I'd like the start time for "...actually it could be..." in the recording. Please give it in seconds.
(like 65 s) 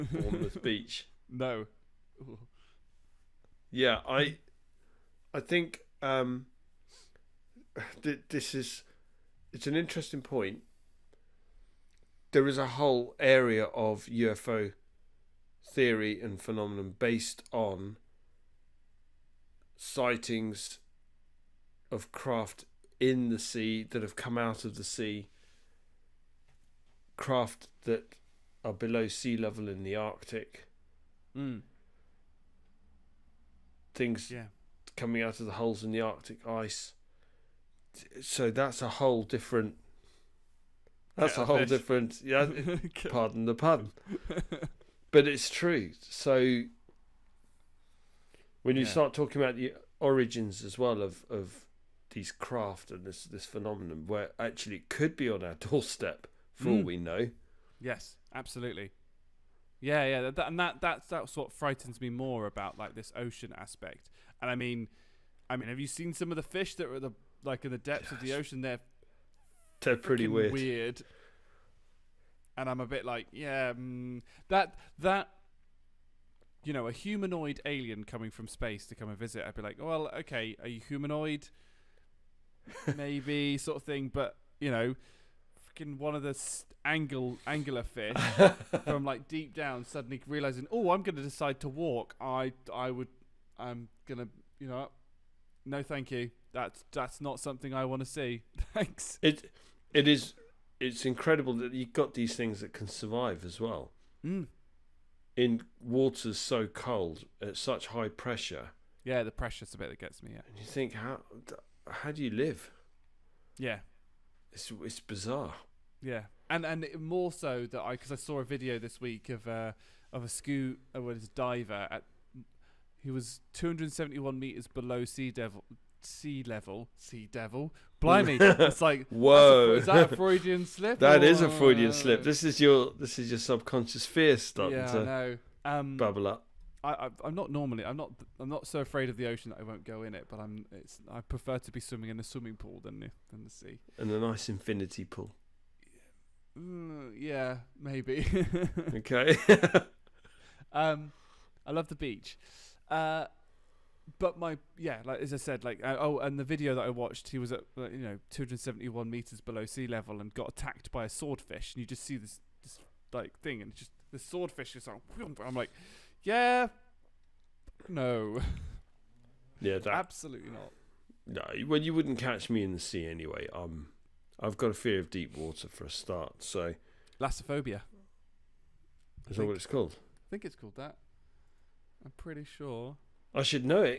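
54 s.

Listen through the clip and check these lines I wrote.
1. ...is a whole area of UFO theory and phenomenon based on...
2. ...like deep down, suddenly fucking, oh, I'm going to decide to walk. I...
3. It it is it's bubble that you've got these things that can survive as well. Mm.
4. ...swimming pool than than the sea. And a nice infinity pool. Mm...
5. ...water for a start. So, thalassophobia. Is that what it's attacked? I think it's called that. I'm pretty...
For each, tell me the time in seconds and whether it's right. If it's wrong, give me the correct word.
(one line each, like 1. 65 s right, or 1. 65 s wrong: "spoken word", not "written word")
1. 12 s right
2. 89 s wrong: "realizing", not "fucking"
3. 99 s wrong: "incredible", not "bubble"
4. 142 s right
5. 175 s wrong: "called", not "attacked".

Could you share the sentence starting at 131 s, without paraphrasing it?
is a freudian slip this is your this is your subconscious fear starting yeah, to I know.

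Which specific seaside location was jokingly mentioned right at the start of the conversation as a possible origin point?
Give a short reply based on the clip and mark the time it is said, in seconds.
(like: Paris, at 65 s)
Bournemouth Beach, at 0 s.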